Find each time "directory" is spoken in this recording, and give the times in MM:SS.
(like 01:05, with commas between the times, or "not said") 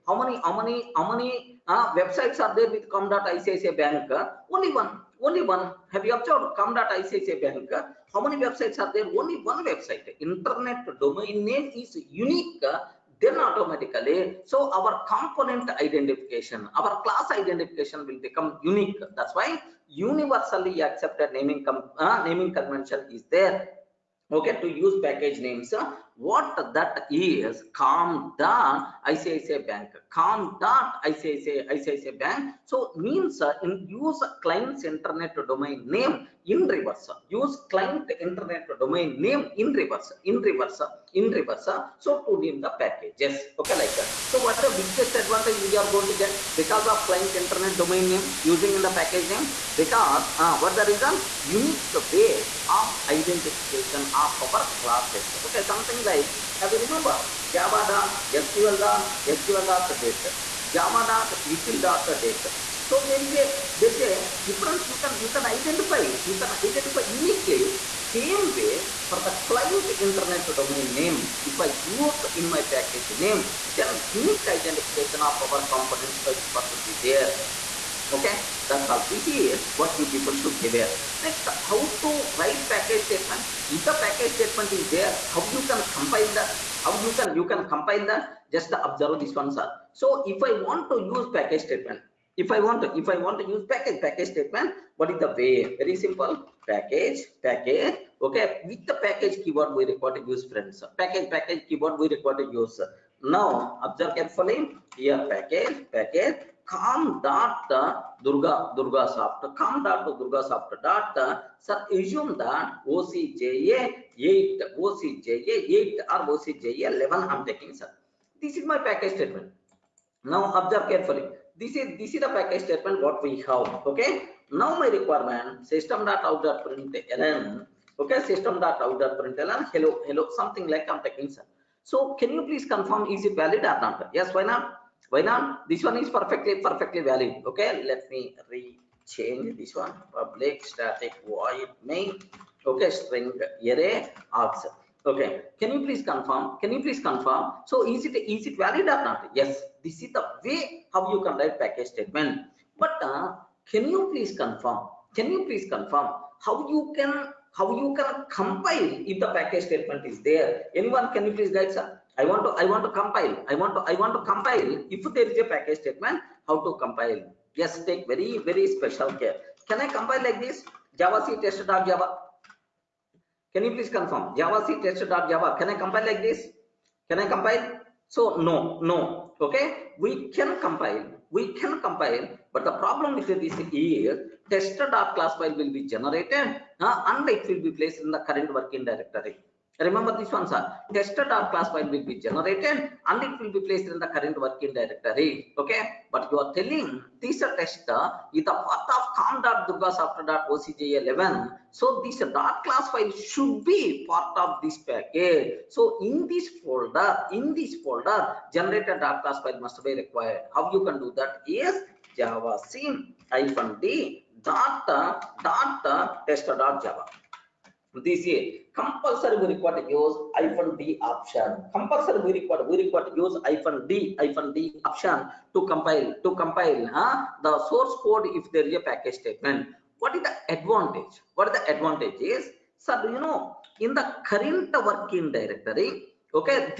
03:08, 03:14, 03:55.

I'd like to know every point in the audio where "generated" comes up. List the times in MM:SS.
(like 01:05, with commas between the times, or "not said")
03:05, 03:12, 03:28.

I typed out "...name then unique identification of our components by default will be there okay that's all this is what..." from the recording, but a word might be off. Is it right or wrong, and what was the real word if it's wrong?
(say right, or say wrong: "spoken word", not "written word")
right.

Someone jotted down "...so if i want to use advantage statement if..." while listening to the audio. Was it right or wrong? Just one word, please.
wrong.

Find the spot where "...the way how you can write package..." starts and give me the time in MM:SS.
02:30.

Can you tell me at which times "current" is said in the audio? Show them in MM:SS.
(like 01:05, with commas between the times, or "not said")
03:08, 03:14, 03:54.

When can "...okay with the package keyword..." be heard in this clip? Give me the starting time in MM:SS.
01:38.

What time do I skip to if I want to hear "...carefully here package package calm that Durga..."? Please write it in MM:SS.
01:44.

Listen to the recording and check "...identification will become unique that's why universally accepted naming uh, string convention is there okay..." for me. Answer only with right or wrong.
wrong.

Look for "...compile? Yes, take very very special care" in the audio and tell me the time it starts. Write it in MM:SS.
02:46.